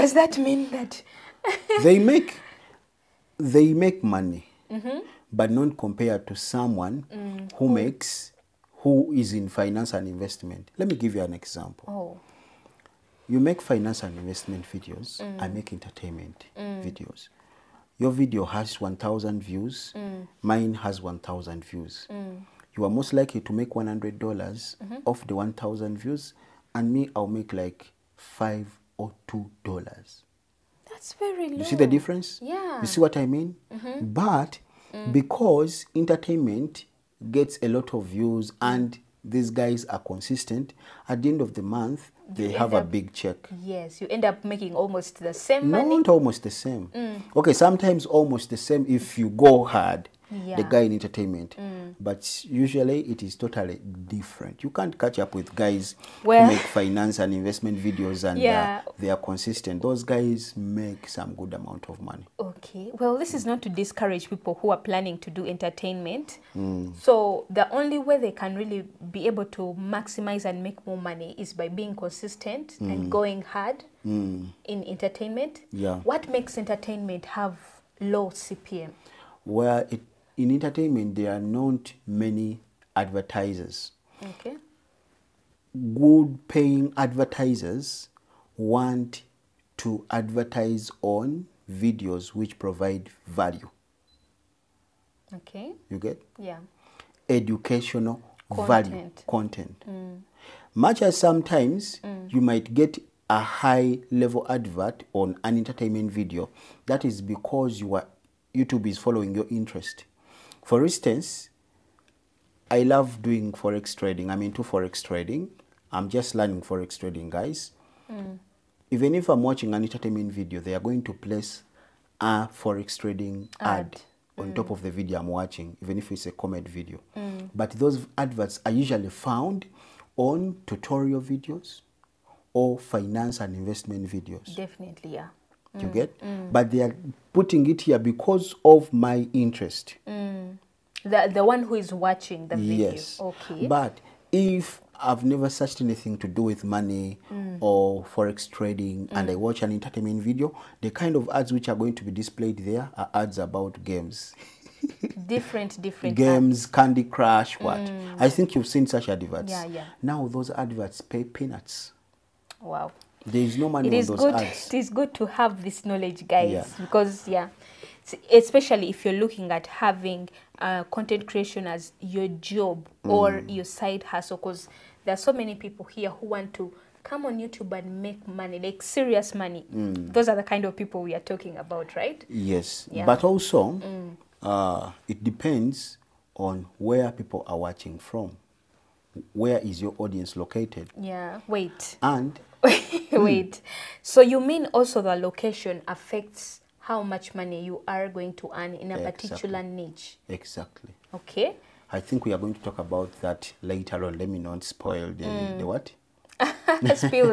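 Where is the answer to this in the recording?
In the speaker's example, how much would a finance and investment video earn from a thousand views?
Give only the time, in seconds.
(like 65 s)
23 s.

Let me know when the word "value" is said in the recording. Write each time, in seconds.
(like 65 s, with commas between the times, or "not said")
93 s, 98 s.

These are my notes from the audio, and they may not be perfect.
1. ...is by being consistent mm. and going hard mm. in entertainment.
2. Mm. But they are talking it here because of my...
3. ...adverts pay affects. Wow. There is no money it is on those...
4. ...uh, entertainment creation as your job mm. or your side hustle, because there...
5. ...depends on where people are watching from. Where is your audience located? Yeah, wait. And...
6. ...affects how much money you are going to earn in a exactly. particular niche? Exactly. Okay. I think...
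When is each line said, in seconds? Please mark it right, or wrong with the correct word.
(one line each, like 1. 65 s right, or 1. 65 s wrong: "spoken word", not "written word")
1. 71 s right
2. 136 s wrong: "putting", not "talking"
3. 160 s wrong: "peanuts", not "affects"
4. 170 s wrong: "content", not "entertainment"
5. 185 s right
6. 195 s right.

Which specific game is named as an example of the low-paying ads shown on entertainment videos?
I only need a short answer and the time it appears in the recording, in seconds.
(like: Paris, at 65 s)
Candy Crush, at 156 s.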